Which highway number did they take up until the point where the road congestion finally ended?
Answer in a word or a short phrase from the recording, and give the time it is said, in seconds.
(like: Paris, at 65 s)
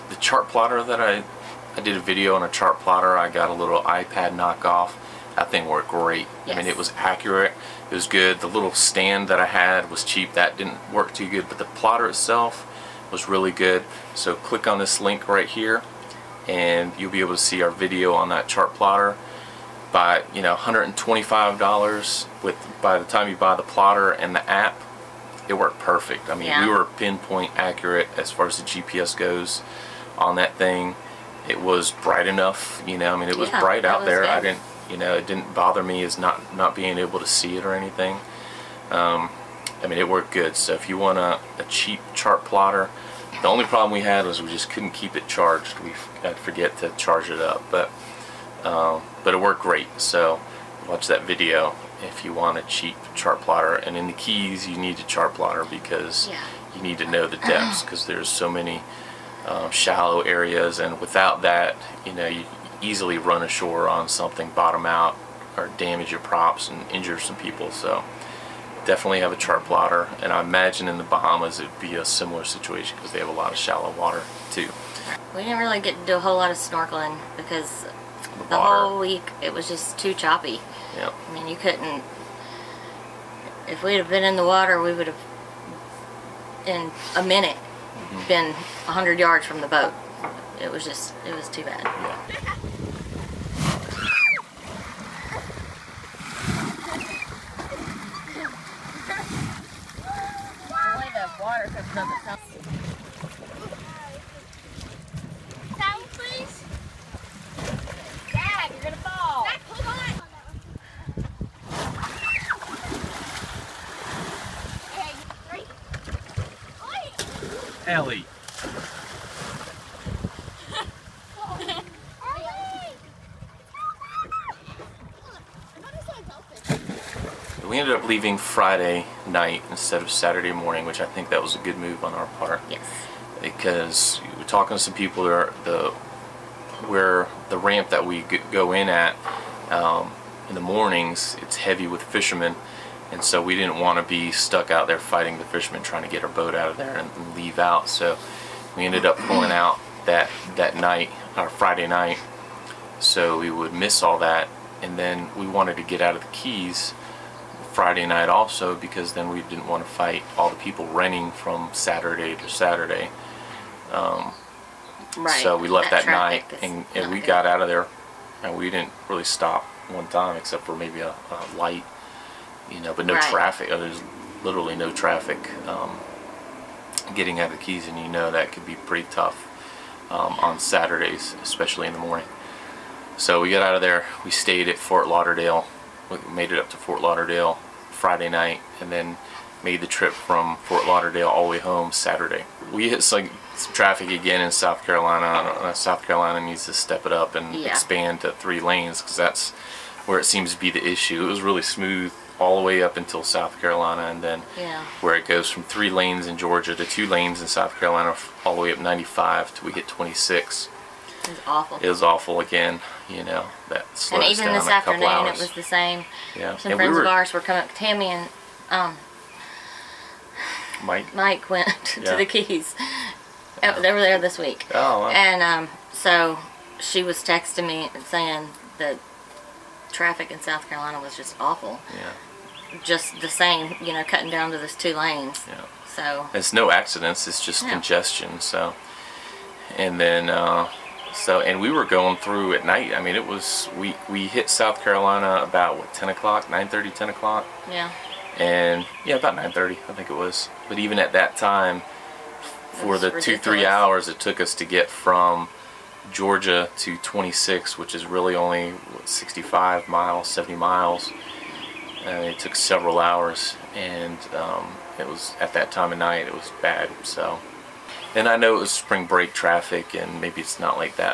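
95, at 208 s.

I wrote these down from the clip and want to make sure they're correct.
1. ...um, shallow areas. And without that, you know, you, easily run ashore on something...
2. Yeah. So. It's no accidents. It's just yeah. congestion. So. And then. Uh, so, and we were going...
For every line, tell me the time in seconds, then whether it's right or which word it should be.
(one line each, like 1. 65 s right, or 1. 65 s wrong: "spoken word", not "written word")
1. 59 s right
2. 235 s right.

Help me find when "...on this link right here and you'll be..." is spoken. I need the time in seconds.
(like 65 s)
14 s.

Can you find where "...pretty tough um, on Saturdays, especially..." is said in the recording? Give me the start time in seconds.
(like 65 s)
178 s.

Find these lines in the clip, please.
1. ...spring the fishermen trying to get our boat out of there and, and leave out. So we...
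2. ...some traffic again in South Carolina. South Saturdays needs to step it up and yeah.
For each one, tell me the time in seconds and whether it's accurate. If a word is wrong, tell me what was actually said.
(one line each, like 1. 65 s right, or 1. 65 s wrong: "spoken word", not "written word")
1. 144 s wrong: "fighting", not "spring"
2. 193 s wrong: "Carolina", not "Saturdays".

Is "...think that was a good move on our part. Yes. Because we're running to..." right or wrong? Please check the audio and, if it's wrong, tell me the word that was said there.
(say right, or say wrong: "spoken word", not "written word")
wrong: "talking", not "running".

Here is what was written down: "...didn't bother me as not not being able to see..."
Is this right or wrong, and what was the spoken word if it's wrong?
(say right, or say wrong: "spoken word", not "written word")
right.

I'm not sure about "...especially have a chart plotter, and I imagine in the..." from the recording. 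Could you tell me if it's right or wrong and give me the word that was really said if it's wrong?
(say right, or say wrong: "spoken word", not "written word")
wrong: "definitely", not "especially".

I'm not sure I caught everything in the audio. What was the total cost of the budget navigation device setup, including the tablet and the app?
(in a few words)
$125.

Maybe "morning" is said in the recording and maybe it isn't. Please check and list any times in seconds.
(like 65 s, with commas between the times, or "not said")
130 s, 140 s, 182 s.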